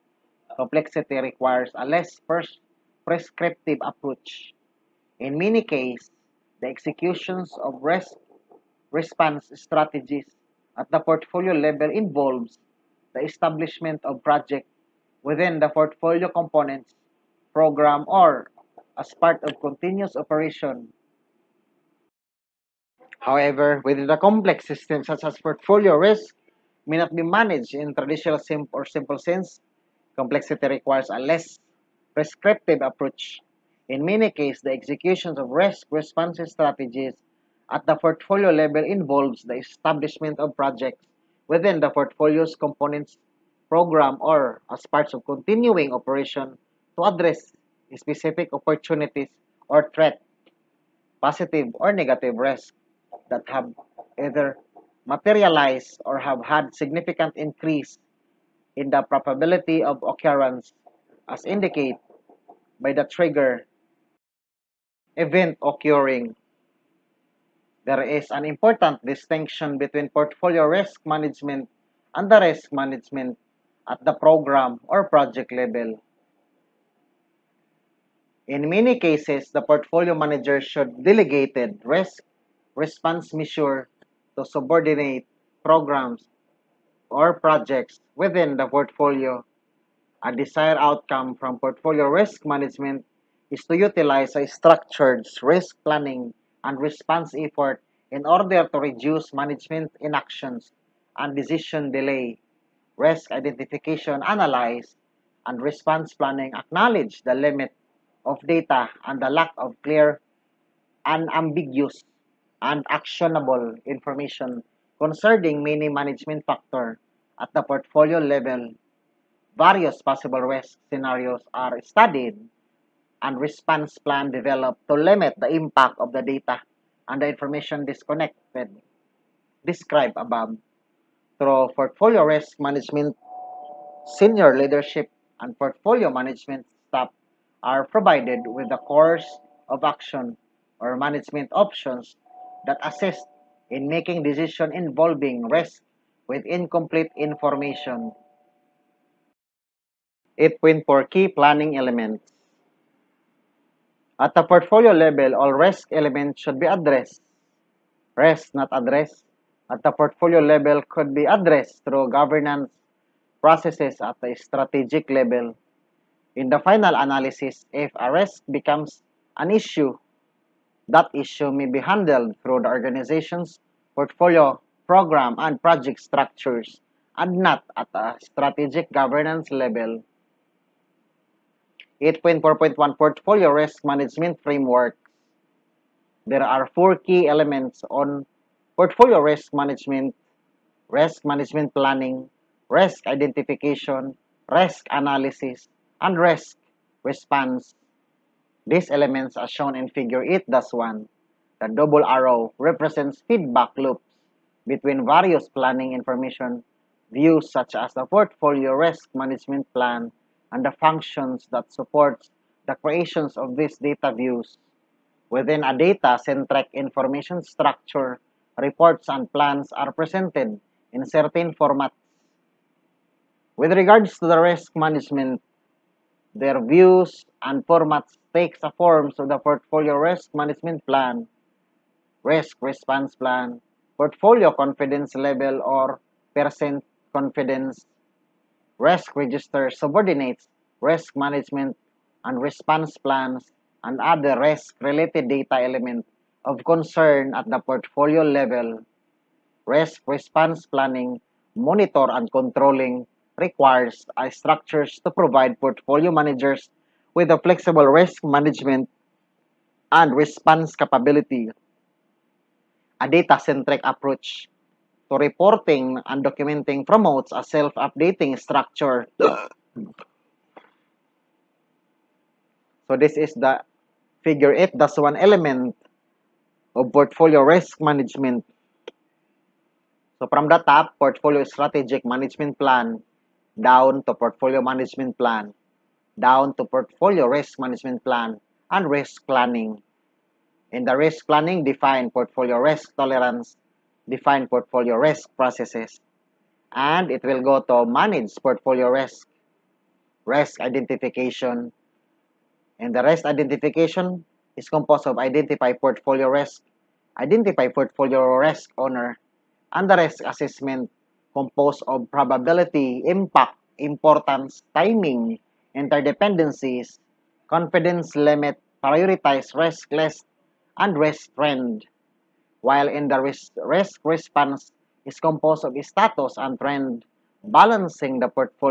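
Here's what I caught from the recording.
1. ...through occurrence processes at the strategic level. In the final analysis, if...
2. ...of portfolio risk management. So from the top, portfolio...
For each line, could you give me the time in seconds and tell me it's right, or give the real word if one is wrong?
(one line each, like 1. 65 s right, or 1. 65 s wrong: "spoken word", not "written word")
1. 161 s wrong: "governance", not "occurrence"
2. 276 s right.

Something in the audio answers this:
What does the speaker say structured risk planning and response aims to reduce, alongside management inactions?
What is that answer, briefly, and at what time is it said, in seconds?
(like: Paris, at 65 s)
decision delay, at 101 s.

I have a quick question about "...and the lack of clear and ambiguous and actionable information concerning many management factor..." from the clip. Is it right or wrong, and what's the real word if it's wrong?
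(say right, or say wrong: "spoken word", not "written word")
right.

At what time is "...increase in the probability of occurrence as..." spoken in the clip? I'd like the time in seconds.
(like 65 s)
57 s.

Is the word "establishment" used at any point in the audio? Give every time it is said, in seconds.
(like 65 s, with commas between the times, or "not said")
13 s, 39 s.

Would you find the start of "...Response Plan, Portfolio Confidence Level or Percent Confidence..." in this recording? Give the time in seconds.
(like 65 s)
232 s.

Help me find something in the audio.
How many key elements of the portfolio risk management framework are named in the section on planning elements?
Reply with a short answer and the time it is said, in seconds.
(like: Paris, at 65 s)
4, at 186 s.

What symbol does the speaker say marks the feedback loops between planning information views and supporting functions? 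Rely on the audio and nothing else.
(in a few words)
double arrow.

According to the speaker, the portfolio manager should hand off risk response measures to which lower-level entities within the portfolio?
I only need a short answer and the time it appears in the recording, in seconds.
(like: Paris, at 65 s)
subordinate programs or projects, at 84 s.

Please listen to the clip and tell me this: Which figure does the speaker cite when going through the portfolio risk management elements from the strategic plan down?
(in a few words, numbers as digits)
8-1.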